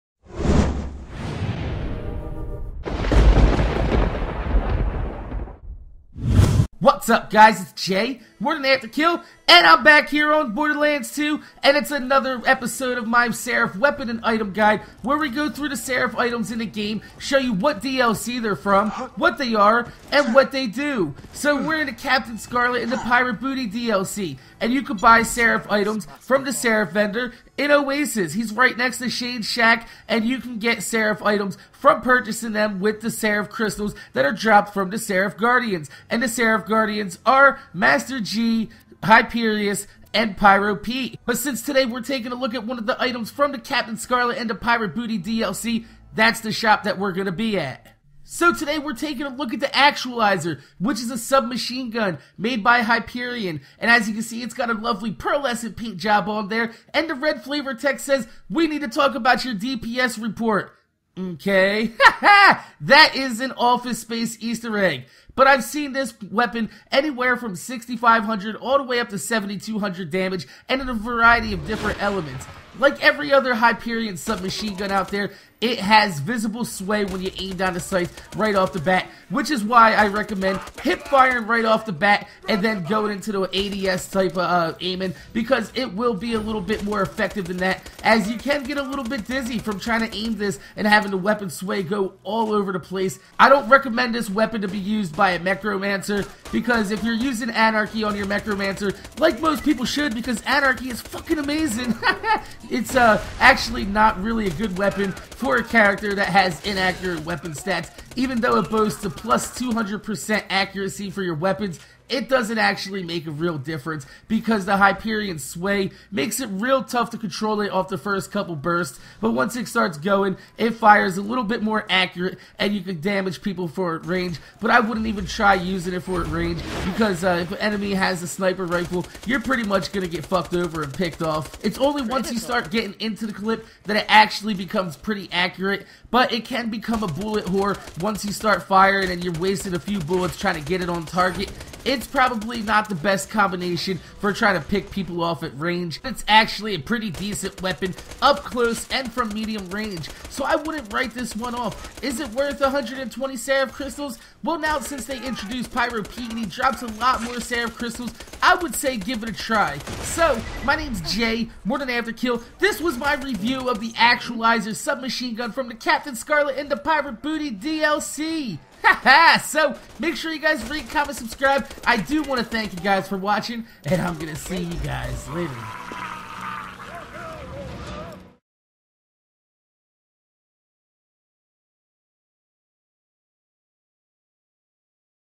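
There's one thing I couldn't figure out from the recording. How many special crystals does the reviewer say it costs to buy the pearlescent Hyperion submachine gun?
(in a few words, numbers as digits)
120.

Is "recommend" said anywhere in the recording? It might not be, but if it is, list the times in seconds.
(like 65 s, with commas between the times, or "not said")
80 s, 93 s.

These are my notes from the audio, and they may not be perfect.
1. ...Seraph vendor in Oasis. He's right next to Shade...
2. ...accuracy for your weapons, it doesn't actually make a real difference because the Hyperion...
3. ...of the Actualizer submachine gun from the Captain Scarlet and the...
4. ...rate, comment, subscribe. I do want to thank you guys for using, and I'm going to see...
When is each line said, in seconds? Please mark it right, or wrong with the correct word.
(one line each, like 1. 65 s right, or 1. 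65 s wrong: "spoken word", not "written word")
1. 26 s right
2. 110 s right
3. 163 s right
4. 170 s wrong: "watching", not "using".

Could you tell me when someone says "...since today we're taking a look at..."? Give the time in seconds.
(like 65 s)
41 s.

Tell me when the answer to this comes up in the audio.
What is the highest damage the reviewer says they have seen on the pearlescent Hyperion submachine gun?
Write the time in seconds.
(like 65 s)
69 s.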